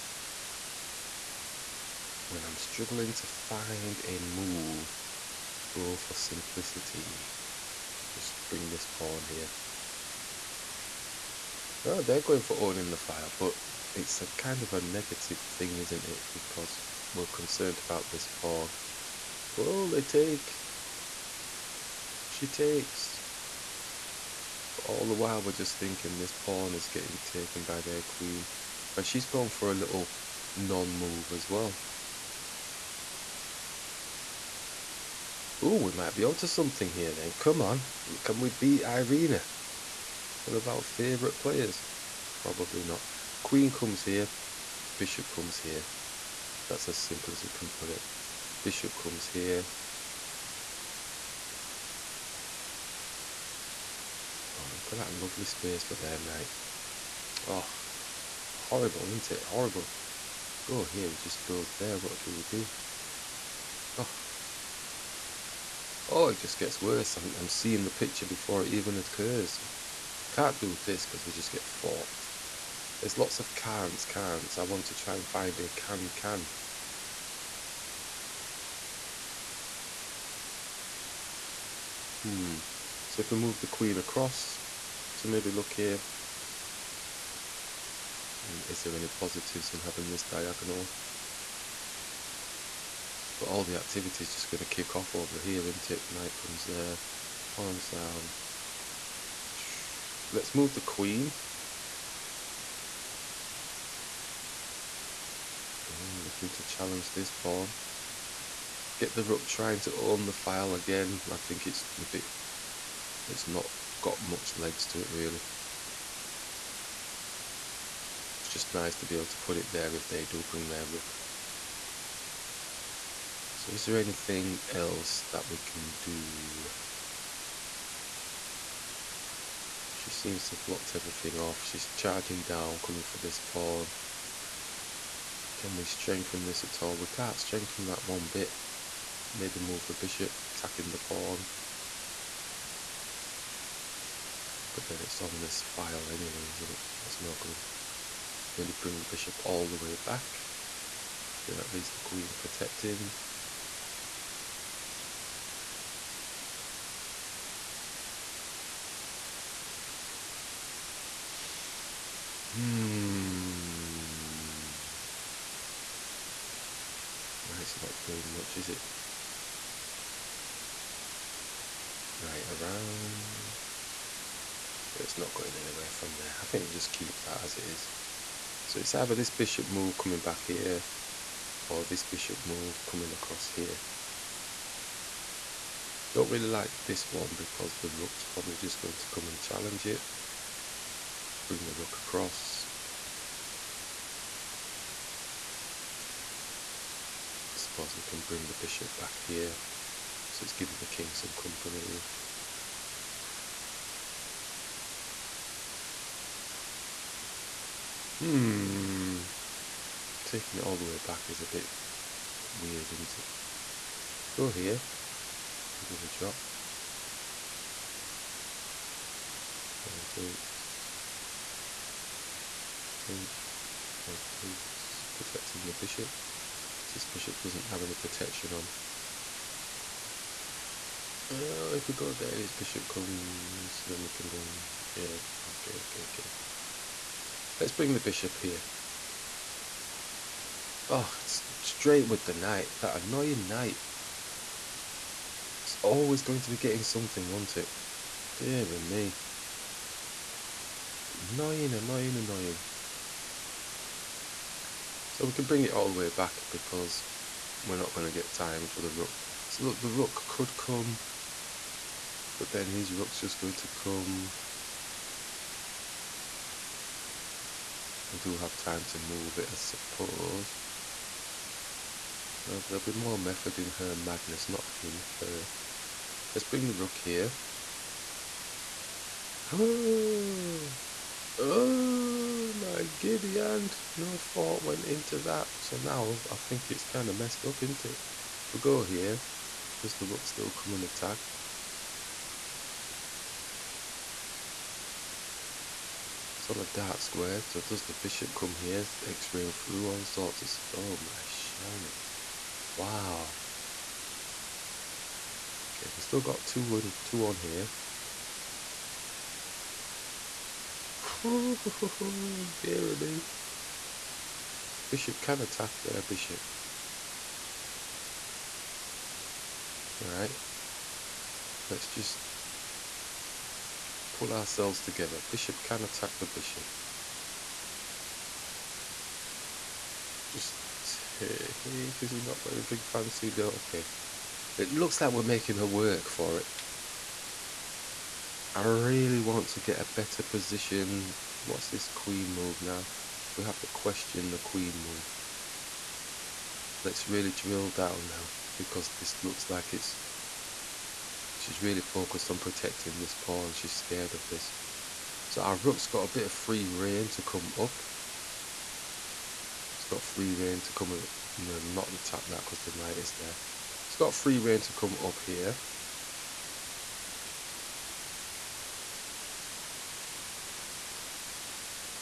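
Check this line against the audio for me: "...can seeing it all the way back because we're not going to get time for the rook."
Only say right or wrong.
wrong.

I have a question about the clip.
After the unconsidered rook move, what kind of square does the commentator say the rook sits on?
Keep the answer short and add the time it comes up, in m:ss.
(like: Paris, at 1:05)
Dark square, at 4:56.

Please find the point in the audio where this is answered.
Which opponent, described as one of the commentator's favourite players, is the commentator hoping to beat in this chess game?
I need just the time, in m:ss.
0:38.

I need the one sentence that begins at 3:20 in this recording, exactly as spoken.
So it's giving the king some company.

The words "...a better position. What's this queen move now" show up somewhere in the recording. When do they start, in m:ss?
5:39.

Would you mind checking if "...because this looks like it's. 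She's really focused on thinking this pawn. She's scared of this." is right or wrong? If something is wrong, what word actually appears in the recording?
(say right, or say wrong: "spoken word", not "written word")
wrong: "protecting", not "thinking".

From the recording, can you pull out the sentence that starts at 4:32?
Well, there'll be more method in her madness, not him, her.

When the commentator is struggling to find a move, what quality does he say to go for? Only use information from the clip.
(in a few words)
Simplicity.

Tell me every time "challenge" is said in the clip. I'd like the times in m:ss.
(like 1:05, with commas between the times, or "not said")
1:46, 3:09.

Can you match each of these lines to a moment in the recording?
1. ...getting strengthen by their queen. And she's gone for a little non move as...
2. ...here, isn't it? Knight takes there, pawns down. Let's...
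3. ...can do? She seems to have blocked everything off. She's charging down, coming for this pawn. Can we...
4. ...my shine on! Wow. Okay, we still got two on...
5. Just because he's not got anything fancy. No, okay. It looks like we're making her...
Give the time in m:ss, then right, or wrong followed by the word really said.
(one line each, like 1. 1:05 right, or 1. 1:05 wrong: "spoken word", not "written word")
1. 0:26 wrong: "taken", not "strengthen"
2. 1:35 wrong: "comes", not "takes"
3. 2:05 right
4. 5:00 right
5. 5:30 right.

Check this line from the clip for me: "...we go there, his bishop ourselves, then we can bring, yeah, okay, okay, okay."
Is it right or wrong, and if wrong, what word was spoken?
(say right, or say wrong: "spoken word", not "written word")
wrong: "comes", not "ourselves".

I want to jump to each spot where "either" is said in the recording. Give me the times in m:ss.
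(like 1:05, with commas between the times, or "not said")
2:58.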